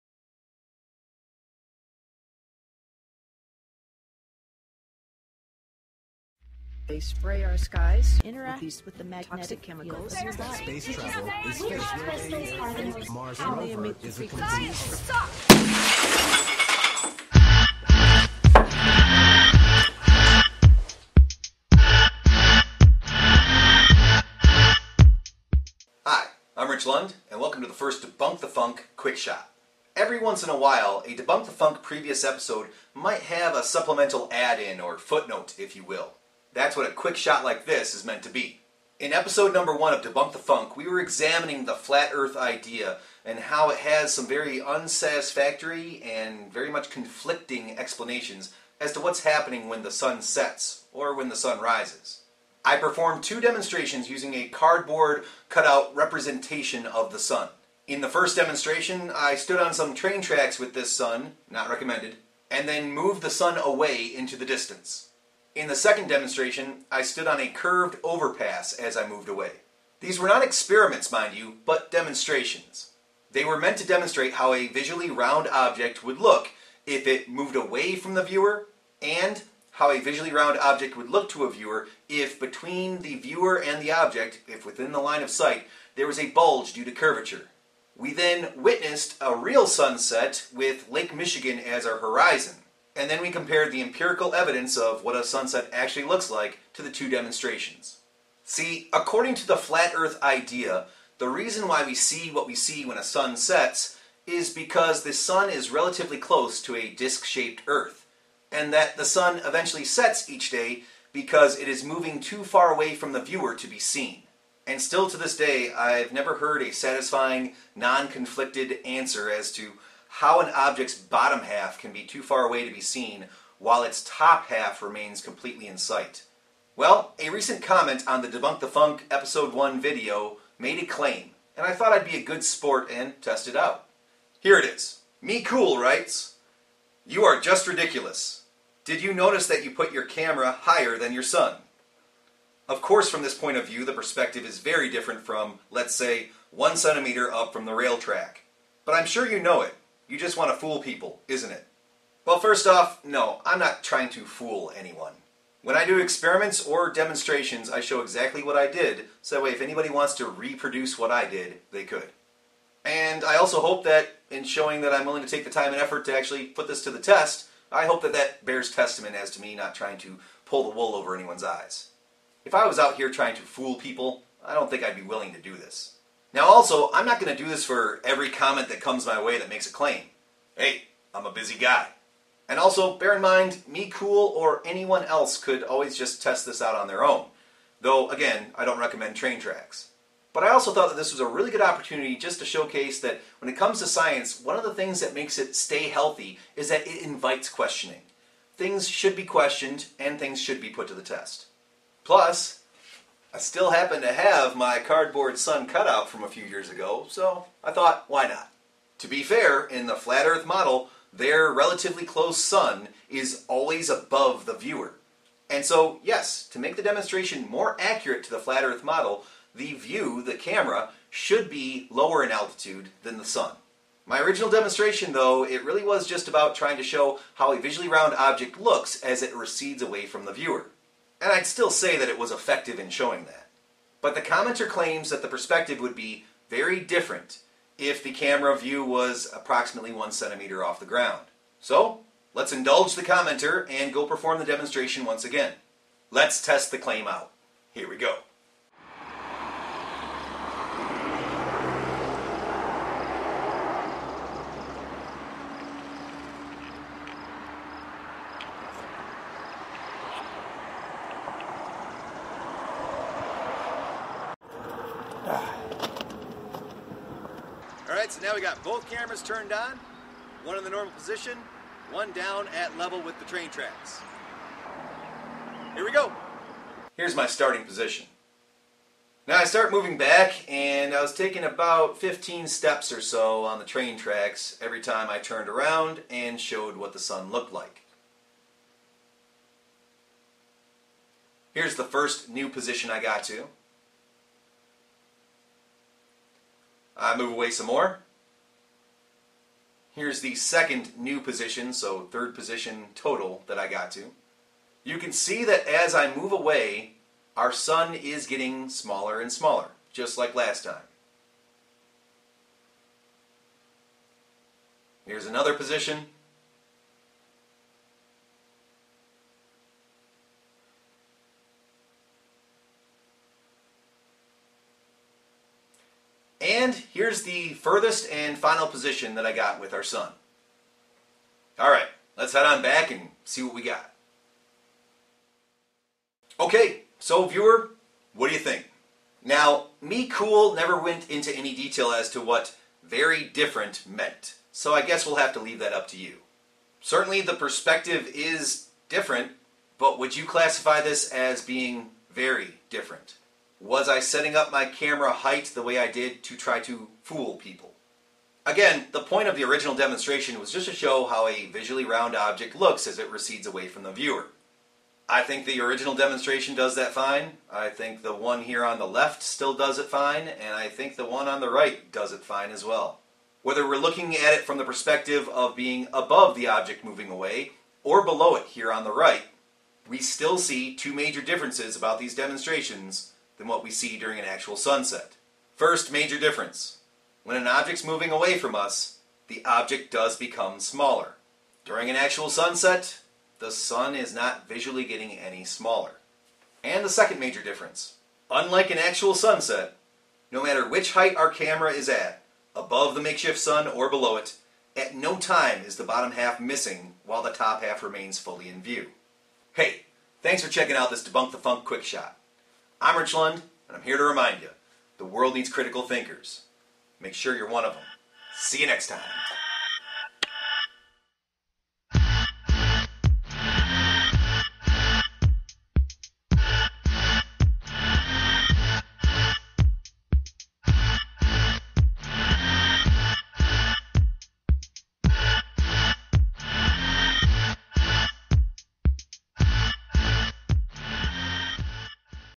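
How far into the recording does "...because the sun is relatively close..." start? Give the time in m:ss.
1:44.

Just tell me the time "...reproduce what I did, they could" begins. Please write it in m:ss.
2:40.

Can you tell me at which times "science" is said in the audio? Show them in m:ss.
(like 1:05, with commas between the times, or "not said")
3:13.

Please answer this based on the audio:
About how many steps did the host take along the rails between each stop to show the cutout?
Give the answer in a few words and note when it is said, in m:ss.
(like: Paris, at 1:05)
15, at 4:41.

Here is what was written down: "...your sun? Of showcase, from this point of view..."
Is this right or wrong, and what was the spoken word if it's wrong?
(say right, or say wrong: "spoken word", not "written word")
wrong: "course", not "showcase".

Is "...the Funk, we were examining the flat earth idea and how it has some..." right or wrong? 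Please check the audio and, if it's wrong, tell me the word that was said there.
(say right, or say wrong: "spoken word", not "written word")
right.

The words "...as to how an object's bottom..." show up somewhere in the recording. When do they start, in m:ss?
1:59.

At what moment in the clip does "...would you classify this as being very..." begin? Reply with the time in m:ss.
5:49.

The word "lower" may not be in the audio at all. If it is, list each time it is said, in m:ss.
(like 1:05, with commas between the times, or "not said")
3:41.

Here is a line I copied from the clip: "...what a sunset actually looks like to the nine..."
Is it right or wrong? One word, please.
wrong.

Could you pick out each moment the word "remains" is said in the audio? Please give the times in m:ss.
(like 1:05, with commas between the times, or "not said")
2:04, 6:47.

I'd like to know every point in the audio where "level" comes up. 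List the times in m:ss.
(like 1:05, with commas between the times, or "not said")
4:32.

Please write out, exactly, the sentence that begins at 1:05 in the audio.
In the second demonstration, I stood on a curved overpass as I moved away.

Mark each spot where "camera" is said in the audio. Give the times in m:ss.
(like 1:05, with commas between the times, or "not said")
2:20, 3:40, 3:58, 4:28, 5:54, 6:41.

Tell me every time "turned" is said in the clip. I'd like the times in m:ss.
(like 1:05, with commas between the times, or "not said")
4:29, 4:45.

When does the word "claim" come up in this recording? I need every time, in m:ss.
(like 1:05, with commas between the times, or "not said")
2:10, 2:59, 3:54, 4:06.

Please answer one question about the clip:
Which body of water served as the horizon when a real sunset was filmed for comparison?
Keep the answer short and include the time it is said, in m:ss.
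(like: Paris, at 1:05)
Lake Michigan, at 1:30.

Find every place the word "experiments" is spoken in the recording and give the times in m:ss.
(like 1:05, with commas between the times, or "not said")
1:10, 2:36.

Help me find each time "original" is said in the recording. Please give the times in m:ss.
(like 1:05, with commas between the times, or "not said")
3:44, 5:59, 6:05.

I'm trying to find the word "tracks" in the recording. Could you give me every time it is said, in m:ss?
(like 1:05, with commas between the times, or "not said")
1:00, 2:27, 3:09, 4:33, 4:43.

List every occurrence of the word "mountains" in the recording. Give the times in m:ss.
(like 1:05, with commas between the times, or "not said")
not said.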